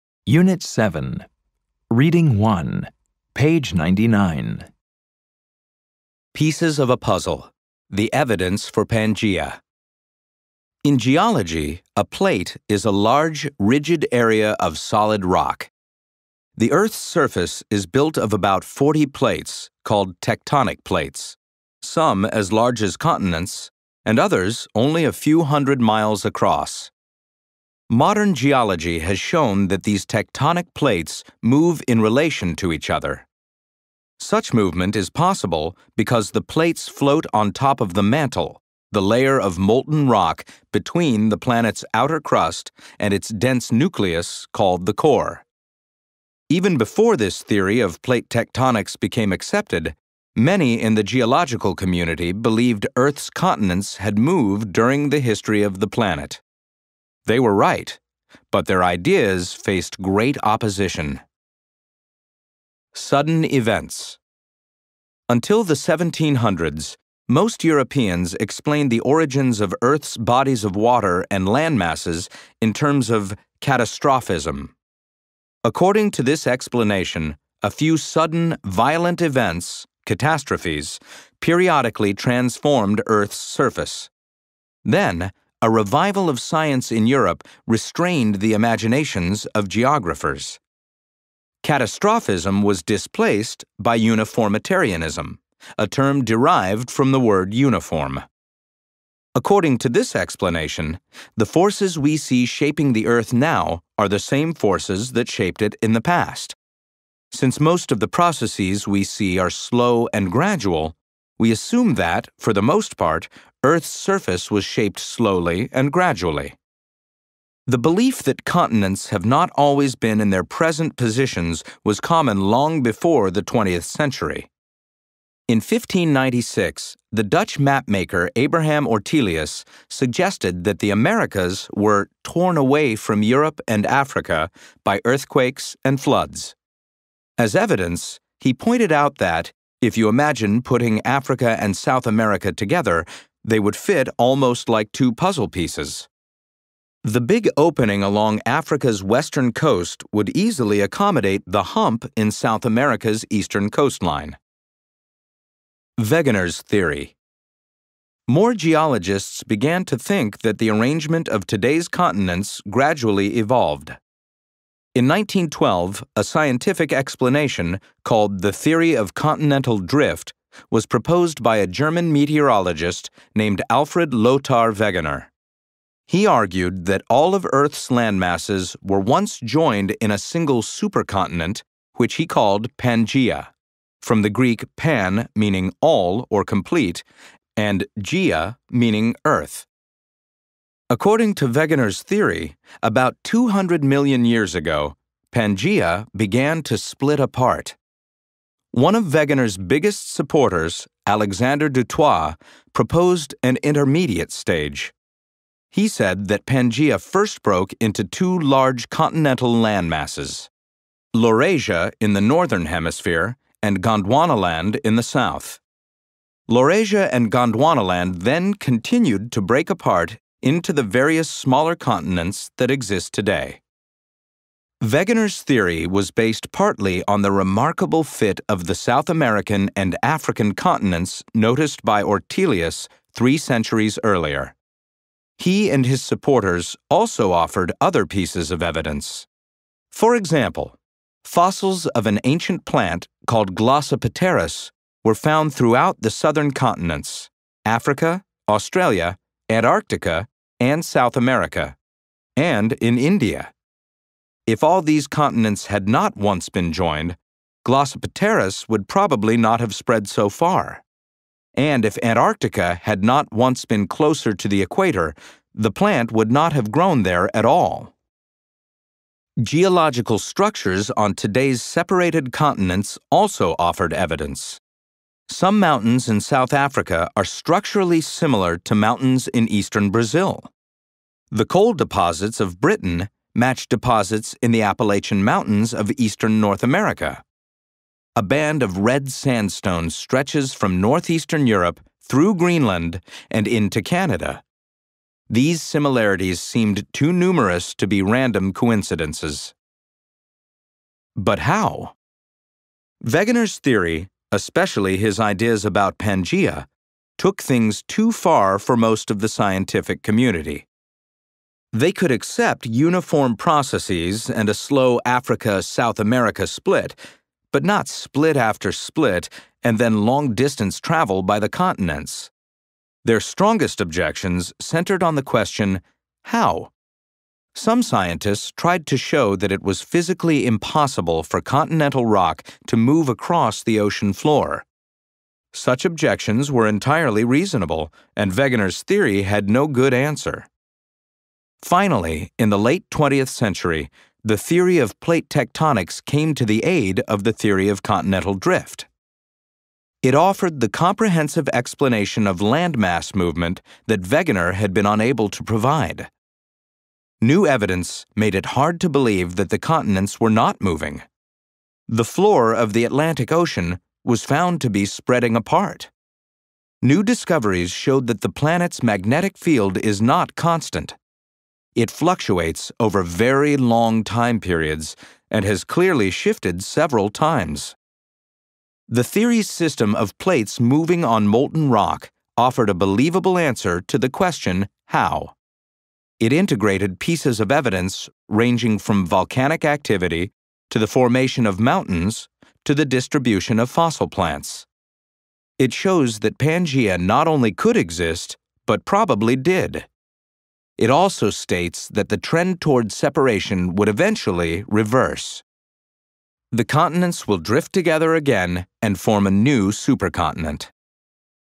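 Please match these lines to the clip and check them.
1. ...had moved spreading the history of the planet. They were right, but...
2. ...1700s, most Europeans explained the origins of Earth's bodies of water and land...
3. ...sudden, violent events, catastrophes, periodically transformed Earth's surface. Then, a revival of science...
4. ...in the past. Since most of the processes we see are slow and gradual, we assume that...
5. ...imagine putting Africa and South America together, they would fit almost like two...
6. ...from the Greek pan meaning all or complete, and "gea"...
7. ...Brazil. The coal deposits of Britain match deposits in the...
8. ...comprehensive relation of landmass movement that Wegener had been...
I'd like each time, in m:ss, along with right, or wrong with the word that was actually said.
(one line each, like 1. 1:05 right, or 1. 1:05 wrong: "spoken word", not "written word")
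1. 0:53 wrong: "during", not "spreading"
2. 1:05 right
3. 1:17 right
4. 1:45 right
5. 2:20 right
6. 3:04 right
7. 4:39 right
8. 5:50 wrong: "explanation", not "relation".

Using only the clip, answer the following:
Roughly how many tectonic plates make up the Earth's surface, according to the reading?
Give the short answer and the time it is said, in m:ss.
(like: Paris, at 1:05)
40, at 0:18.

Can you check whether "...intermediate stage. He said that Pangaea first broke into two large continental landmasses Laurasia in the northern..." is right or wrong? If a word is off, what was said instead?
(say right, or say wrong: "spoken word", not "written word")
right.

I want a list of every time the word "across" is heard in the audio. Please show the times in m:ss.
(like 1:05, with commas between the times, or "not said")
0:26, 5:33.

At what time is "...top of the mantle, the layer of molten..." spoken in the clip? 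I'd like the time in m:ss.
0:37.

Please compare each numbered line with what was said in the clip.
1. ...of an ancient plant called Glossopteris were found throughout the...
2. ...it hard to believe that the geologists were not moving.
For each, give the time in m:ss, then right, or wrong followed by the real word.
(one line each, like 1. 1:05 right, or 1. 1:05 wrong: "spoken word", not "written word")
1. 4:01 right
2. 5:58 wrong: "continents", not "geologists".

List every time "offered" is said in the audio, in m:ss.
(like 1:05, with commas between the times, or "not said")
3:57, 4:33, 5:50, 6:22.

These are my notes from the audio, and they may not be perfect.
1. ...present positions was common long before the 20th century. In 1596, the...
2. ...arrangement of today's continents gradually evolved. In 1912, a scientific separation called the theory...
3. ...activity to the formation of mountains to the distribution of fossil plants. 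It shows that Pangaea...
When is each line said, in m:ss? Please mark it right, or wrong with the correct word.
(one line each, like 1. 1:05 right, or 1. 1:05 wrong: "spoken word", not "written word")
1. 2:00 right
2. 2:40 wrong: "explanation", not "separation"
3. 6:29 right.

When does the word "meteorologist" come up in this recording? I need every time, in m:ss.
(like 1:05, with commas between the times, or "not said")
2:52.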